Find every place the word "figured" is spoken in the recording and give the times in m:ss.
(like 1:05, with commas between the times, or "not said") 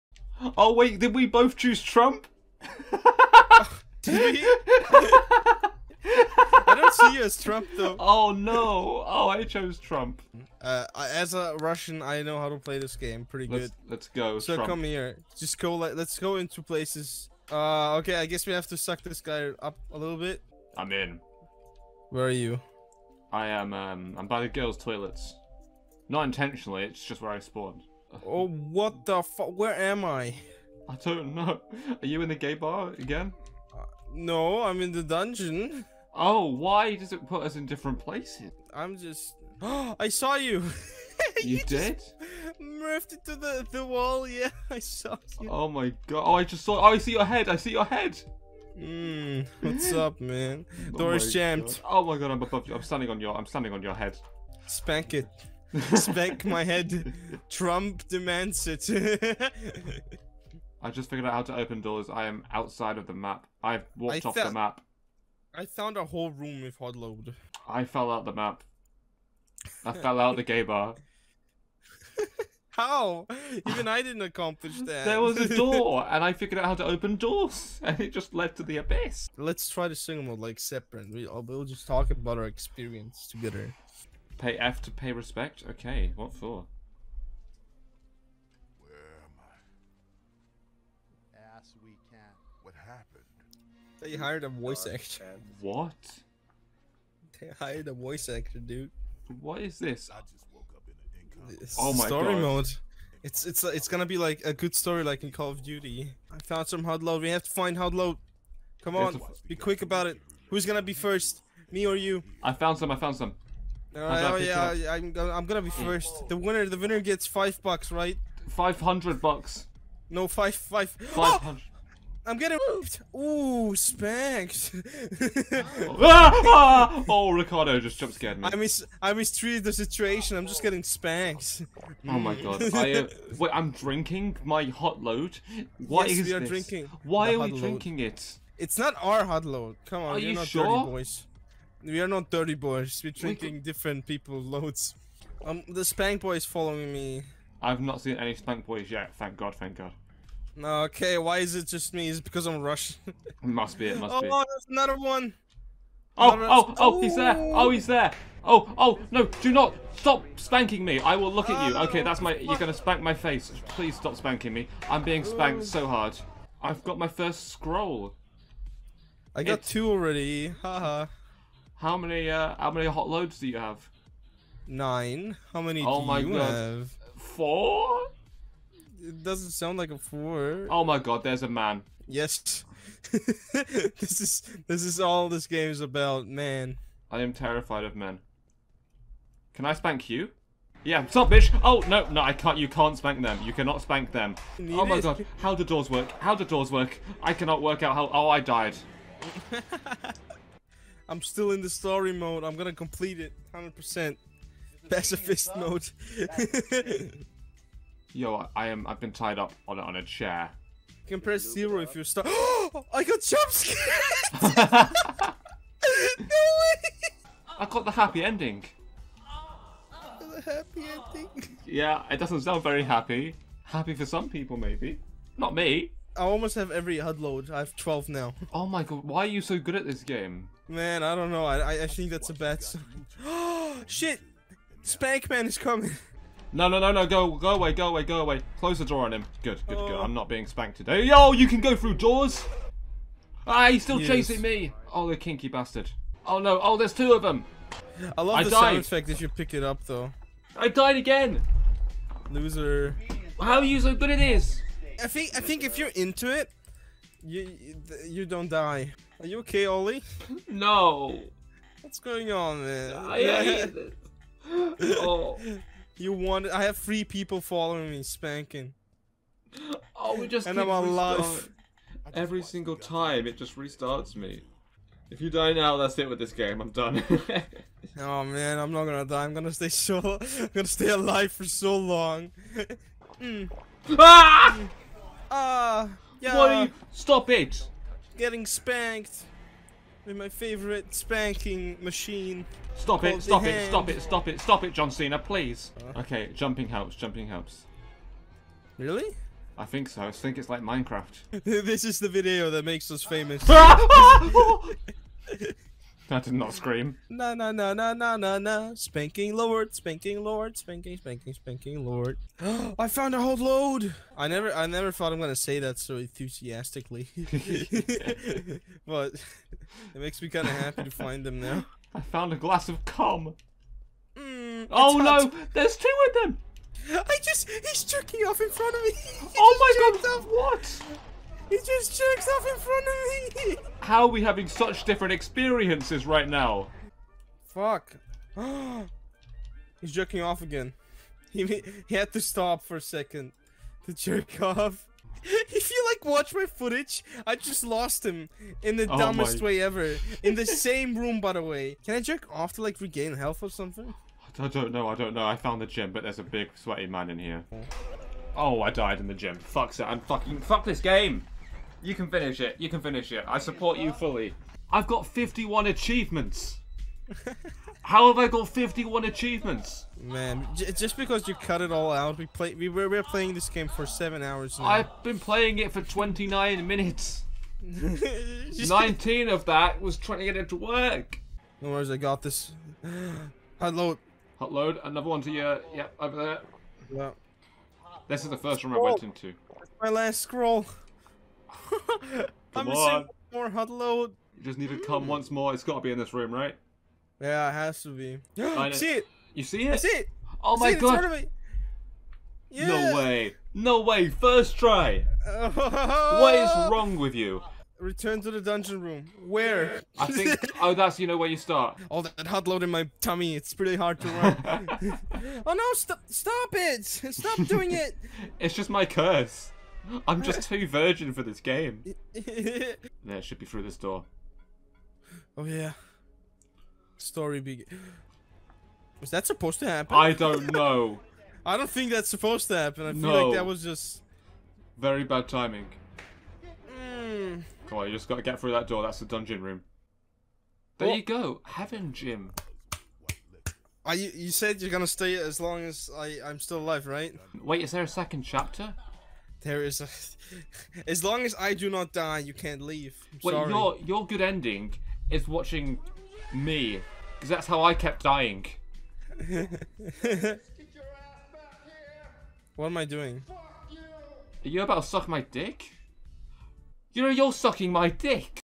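1:01, 1:16.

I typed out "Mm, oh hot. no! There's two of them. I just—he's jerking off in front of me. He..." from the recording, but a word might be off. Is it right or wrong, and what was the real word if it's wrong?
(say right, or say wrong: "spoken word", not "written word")
right.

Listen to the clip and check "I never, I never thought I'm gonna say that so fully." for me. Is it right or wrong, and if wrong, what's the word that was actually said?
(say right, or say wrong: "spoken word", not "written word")
wrong: "enthusiastically", not "fully".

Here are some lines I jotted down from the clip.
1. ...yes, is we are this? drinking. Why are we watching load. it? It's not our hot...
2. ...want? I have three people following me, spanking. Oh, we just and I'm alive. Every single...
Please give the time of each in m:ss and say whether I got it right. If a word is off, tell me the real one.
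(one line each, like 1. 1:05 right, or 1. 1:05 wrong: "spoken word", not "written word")
1. 2:16 wrong: "drinking", not "watching"
2. 4:26 right.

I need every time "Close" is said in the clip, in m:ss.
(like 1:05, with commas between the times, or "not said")
3:58.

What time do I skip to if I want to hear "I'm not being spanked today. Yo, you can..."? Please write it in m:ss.
3:59.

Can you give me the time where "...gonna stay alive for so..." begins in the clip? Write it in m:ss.
4:40.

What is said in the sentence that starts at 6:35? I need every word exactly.
It's got to be in this room, right?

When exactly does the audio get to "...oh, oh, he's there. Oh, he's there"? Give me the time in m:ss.
2:36.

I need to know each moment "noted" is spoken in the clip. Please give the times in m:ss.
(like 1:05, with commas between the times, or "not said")
not said.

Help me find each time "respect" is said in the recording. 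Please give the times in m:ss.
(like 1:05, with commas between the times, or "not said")
1:25.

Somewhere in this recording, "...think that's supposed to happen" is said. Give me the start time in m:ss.
7:11.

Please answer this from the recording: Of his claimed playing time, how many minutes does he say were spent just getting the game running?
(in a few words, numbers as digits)
19.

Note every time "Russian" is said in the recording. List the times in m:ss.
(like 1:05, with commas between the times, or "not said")
0:11, 2:32.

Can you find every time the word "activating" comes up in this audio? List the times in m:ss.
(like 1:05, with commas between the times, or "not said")
not said.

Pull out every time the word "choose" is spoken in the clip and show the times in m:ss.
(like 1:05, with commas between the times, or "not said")
0:01.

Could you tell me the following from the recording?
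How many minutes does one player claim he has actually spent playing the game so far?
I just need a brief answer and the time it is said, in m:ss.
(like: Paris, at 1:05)
29 minutes, at 6:15.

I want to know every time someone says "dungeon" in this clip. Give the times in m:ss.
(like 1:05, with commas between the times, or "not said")
0:35, 6:48, 7:19.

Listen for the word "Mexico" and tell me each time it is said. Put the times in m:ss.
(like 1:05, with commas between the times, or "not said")
not said.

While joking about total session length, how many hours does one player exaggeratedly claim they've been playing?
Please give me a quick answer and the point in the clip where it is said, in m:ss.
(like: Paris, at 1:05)
7 hours, at 6:13.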